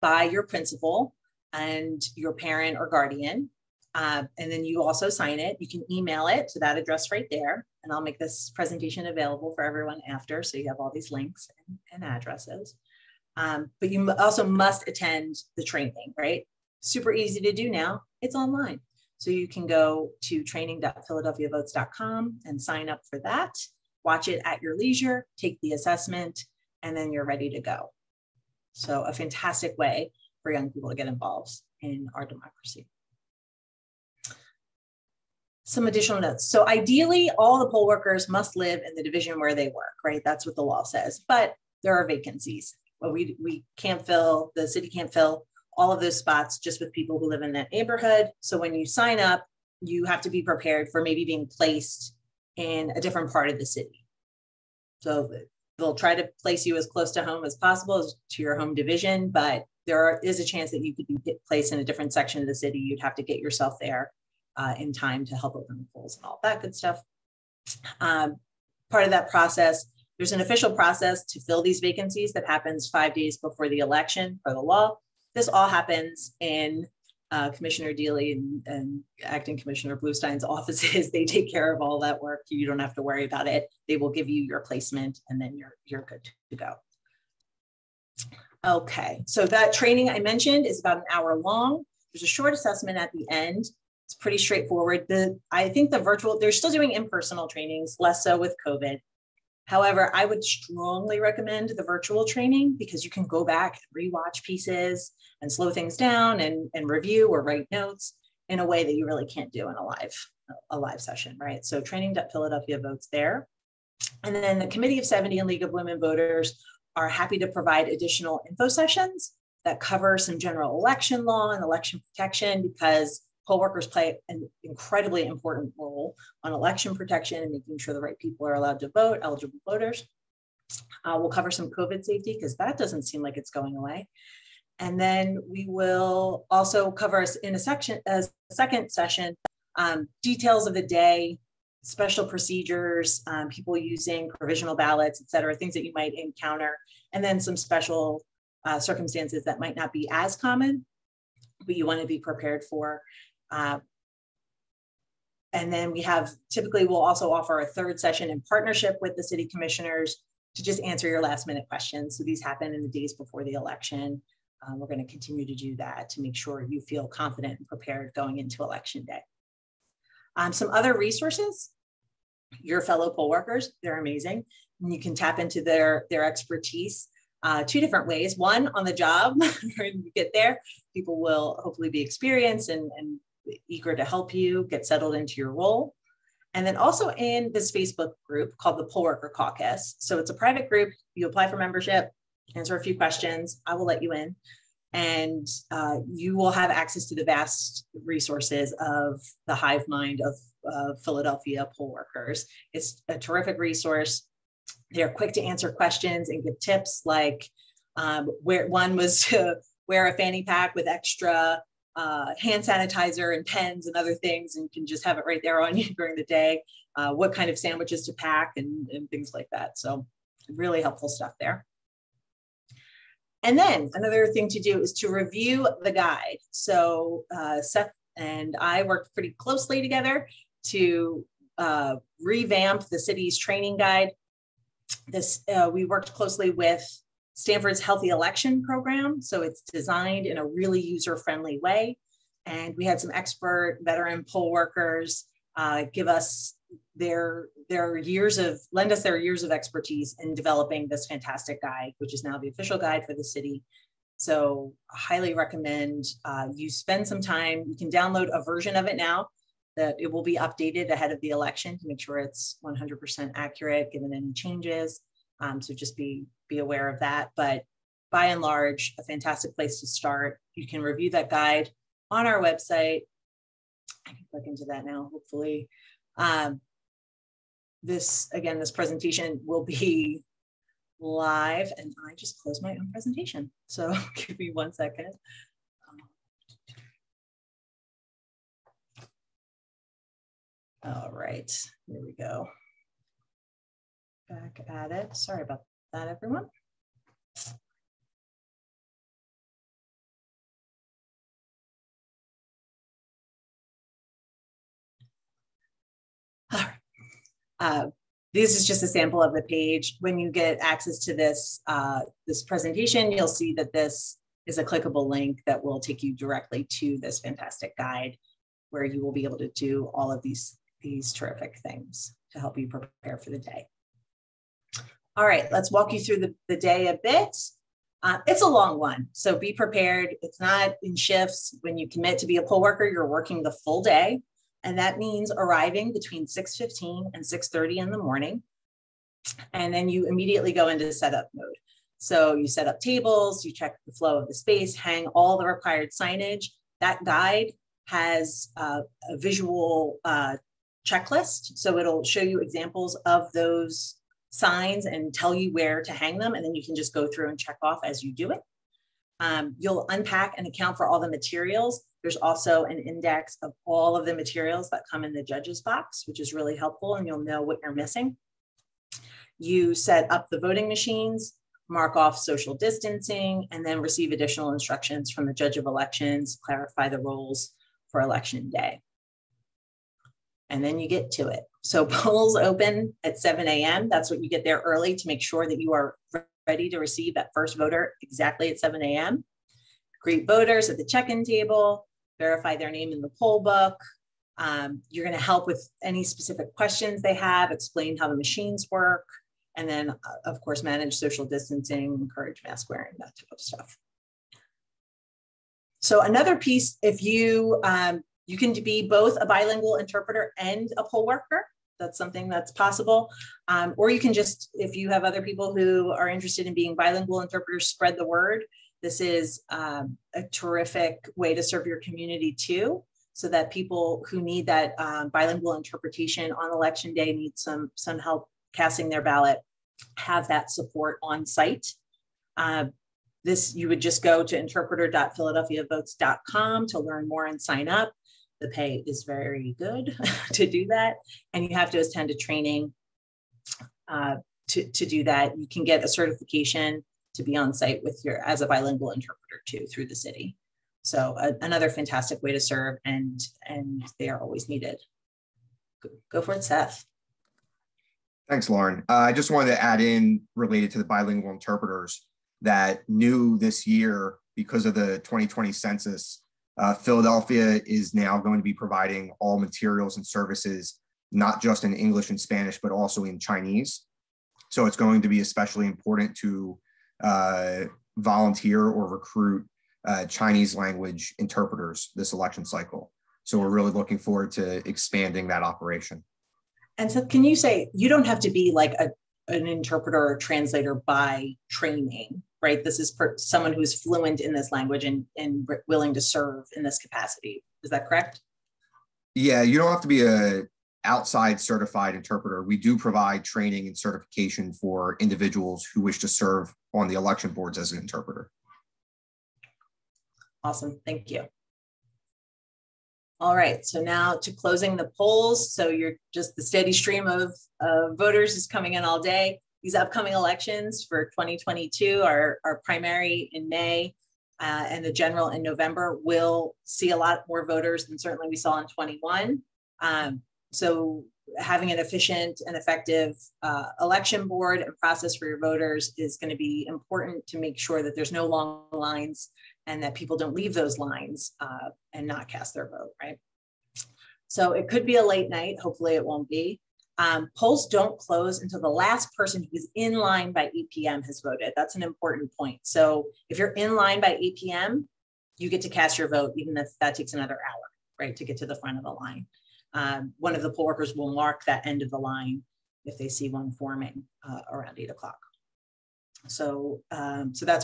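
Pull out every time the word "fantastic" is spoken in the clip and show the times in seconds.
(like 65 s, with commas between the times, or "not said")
29 s, 251 s, 269 s, 317 s, 451 s.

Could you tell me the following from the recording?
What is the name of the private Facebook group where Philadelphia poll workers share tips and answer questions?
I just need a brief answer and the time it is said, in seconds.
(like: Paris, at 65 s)
Poll Worker Caucus, at 188 s.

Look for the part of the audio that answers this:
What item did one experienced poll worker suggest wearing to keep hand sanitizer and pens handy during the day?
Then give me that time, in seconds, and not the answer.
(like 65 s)
210 s.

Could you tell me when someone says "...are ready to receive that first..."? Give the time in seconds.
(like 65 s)
385 s.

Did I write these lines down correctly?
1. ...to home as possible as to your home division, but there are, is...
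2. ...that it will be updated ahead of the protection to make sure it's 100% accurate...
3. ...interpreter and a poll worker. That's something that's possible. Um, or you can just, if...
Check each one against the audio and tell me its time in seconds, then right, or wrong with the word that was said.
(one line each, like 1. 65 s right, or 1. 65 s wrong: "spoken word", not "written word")
1. 57 s right
2. 259 s wrong: "election", not "protection"
3. 409 s right.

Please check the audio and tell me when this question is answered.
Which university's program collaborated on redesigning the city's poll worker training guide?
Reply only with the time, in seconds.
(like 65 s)
237 s.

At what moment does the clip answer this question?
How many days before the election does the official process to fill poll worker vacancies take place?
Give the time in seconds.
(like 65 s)
72 s.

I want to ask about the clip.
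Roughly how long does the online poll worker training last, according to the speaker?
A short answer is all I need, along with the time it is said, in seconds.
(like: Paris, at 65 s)
About an hour, at 90 s.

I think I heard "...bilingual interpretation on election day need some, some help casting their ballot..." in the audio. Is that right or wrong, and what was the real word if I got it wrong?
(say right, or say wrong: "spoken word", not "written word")
right.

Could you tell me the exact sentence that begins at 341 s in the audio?
So you set up tables, you check the flow of the space, hang all the required signage.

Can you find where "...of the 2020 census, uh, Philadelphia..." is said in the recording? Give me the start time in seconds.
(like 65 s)
464 s.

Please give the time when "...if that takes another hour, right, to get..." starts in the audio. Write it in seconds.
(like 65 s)
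556 s.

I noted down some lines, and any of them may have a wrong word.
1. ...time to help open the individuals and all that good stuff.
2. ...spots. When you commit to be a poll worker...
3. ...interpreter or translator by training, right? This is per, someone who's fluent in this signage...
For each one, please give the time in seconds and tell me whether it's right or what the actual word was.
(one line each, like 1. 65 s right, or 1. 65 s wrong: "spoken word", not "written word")
1. 64 s wrong: "polls", not "individuals"
2. 330 s wrong: "shifts", not "spots"
3. 489 s wrong: "language", not "signage".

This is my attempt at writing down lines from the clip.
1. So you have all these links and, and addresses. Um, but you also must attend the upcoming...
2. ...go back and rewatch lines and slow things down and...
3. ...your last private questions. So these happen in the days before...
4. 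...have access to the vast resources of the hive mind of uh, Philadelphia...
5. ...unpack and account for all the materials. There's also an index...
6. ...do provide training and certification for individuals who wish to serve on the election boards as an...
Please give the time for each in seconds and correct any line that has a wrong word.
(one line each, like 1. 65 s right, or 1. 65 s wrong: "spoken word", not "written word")
1. 10 s wrong: "training", not "upcoming"
2. 103 s wrong: "pieces", not "lines"
3. 161 s wrong: "minute", not "private"
4. 196 s right
5. 359 s right
6. 502 s right.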